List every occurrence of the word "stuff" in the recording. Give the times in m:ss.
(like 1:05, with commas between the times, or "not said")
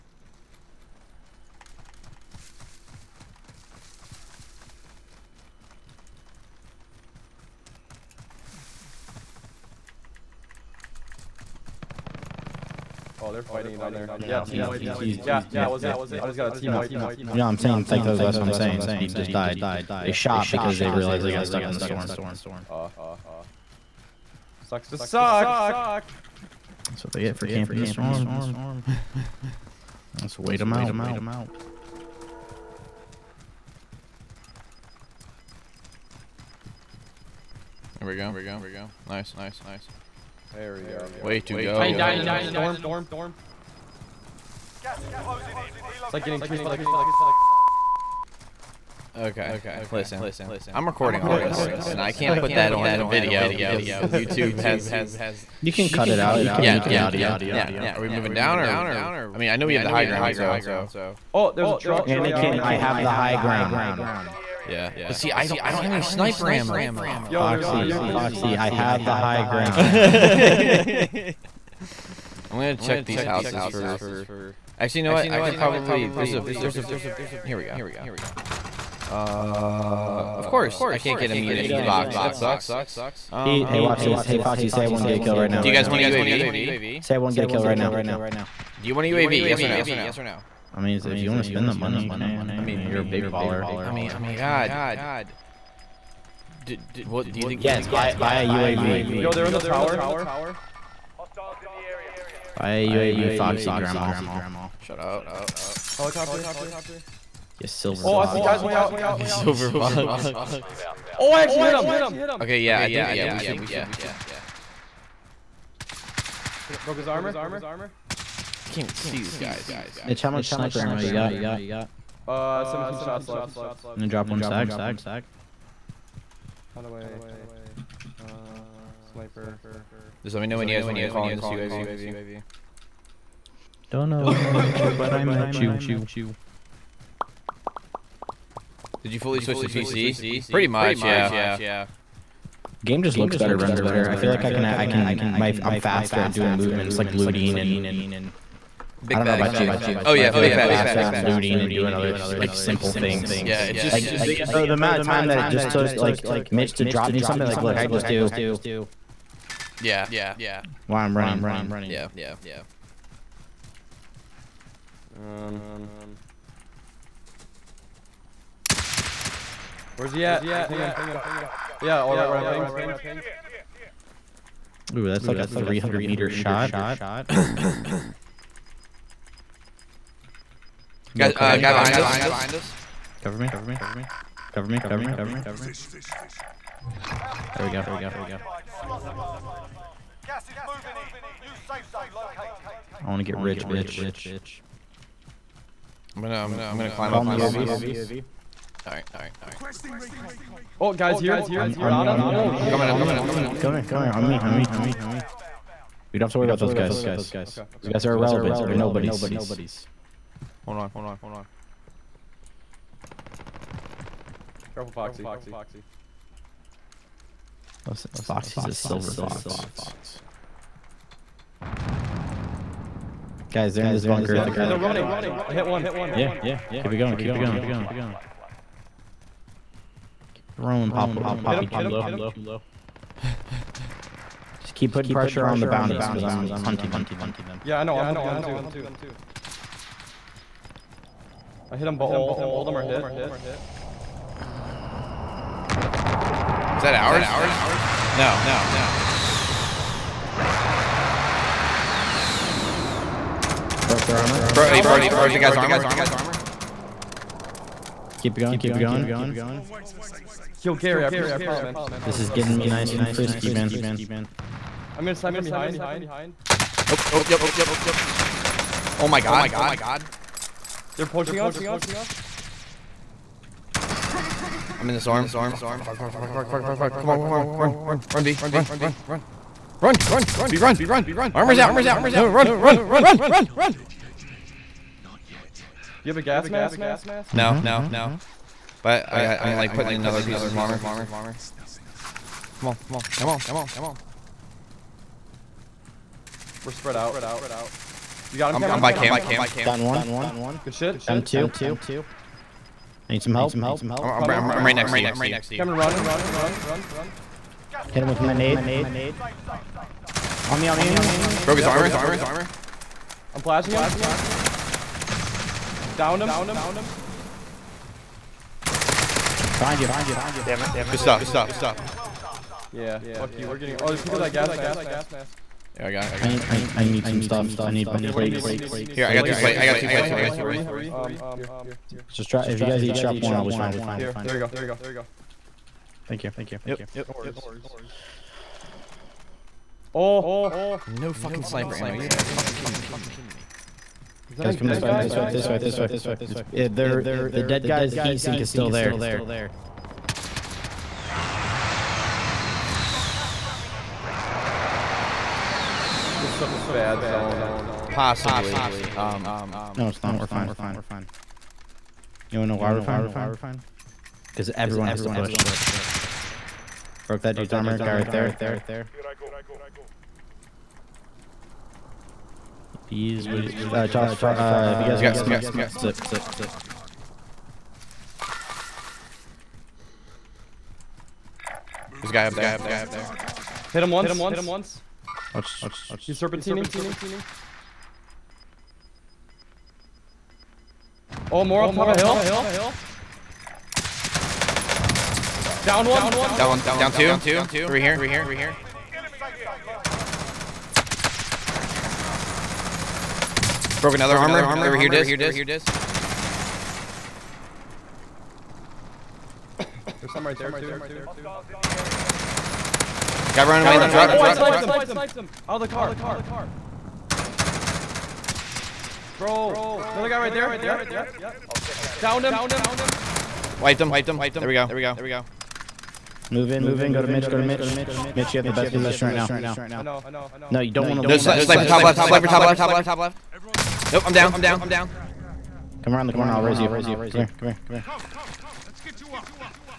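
5:20, 5:27.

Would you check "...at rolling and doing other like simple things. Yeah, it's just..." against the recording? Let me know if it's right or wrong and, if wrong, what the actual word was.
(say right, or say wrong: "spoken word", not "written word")
wrong: "looting", not "rolling".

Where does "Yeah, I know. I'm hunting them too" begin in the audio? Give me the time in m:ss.
3:57.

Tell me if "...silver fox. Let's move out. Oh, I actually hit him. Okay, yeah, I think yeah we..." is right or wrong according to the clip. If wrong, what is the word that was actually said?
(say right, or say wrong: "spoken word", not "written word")
right.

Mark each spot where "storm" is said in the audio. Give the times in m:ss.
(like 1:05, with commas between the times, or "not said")
0:21, 0:27, 0:42.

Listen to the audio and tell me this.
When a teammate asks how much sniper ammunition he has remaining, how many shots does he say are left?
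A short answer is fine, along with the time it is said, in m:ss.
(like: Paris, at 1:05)
17, at 2:02.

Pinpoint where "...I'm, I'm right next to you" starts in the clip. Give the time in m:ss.
5:04.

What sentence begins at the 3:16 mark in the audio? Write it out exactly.
I'm gonna um, I'm gonna climb Call up.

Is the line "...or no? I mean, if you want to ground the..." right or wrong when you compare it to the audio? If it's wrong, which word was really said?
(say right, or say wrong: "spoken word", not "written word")
wrong: "spend", not "ground".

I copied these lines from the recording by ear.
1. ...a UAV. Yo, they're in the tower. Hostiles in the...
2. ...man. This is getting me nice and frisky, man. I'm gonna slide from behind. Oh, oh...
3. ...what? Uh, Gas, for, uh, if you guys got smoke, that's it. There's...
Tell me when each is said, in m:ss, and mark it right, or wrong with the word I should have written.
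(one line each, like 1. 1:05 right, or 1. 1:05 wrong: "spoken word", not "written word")
1. 1:38 right
2. 4:21 right
3. 6:13 wrong: "Josh", not "Gas".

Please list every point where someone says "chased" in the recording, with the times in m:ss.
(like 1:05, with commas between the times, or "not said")
0:46.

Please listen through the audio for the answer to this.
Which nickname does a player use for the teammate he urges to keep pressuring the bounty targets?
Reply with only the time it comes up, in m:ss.
3:51.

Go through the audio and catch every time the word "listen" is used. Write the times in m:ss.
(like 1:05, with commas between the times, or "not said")
0:49, 3:37.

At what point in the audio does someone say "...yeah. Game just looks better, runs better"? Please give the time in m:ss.
2:21.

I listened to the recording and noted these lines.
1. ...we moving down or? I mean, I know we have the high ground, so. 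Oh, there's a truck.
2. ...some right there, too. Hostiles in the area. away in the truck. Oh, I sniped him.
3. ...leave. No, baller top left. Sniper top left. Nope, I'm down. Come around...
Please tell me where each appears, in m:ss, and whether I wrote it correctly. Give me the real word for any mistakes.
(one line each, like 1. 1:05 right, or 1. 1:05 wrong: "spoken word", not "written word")
1. 0:58 right
2. 6:50 right
3. 7:11 wrong: "sniper", not "baller".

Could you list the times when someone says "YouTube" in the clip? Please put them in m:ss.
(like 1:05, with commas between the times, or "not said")
0:53.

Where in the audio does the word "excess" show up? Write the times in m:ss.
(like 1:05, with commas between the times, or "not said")
not said.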